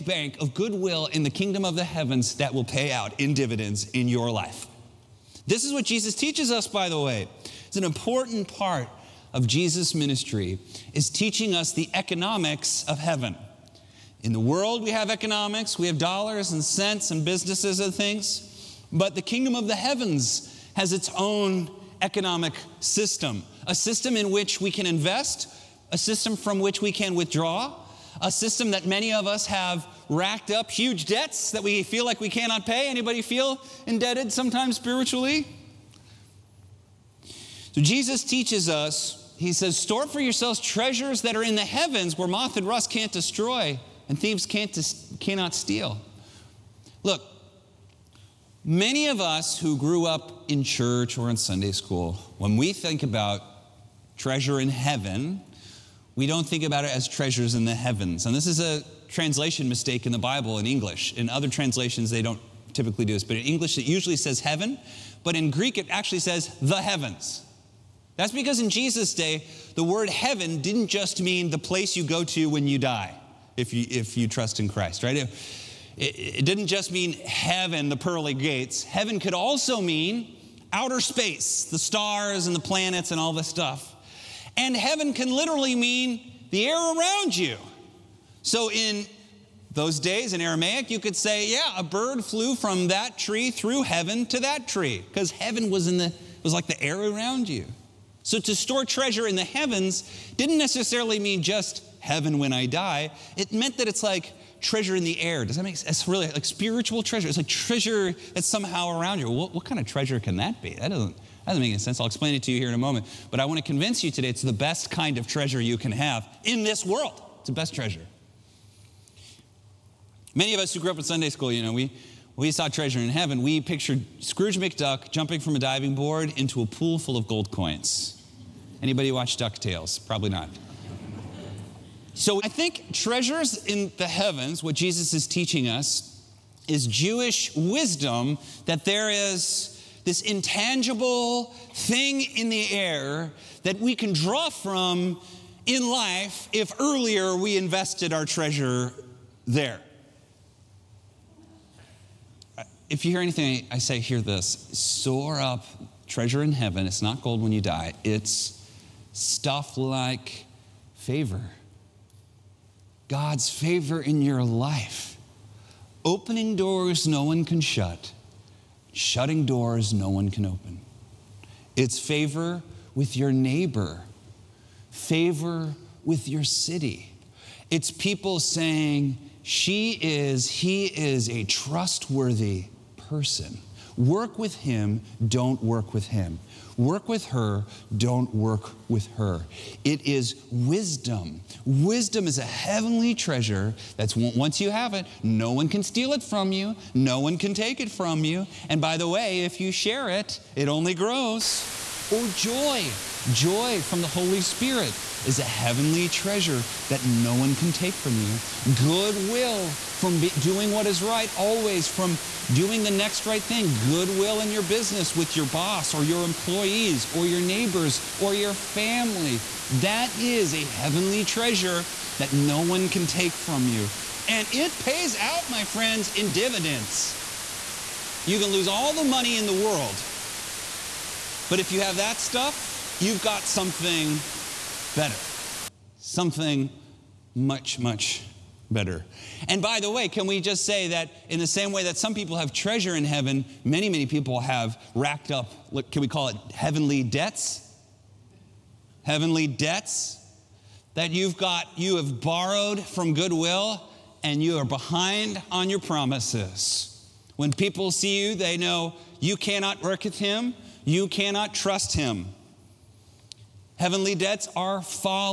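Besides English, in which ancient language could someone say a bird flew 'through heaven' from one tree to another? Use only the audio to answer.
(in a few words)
Aramaic.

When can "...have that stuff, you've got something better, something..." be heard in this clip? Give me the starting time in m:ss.
3:51.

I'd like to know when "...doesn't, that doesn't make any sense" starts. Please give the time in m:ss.
1:50.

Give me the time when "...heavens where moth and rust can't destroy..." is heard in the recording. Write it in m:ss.
0:41.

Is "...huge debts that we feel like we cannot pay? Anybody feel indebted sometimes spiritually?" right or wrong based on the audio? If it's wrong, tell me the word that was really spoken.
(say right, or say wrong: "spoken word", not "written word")
right.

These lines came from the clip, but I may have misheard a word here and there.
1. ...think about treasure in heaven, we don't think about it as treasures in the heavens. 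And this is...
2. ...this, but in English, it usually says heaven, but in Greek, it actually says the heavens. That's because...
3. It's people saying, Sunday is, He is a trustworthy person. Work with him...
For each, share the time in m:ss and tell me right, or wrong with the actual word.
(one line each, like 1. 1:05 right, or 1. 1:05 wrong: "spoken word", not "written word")
1. 0:52 right
2. 1:03 right
3. 2:57 wrong: "She", not "Sunday".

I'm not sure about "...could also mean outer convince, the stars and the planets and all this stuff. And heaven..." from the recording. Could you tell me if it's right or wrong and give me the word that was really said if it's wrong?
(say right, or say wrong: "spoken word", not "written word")
wrong: "space", not "convince".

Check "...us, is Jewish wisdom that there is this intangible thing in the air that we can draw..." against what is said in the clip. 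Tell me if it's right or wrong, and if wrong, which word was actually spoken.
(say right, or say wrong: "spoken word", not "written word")
right.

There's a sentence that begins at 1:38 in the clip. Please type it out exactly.
So to store treasure in the heavens didn't necessarily mean just heaven when I die.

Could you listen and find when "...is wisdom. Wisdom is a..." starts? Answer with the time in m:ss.
3:10.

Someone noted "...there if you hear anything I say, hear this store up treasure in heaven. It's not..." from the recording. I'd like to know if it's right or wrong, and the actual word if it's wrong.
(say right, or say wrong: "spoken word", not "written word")
right.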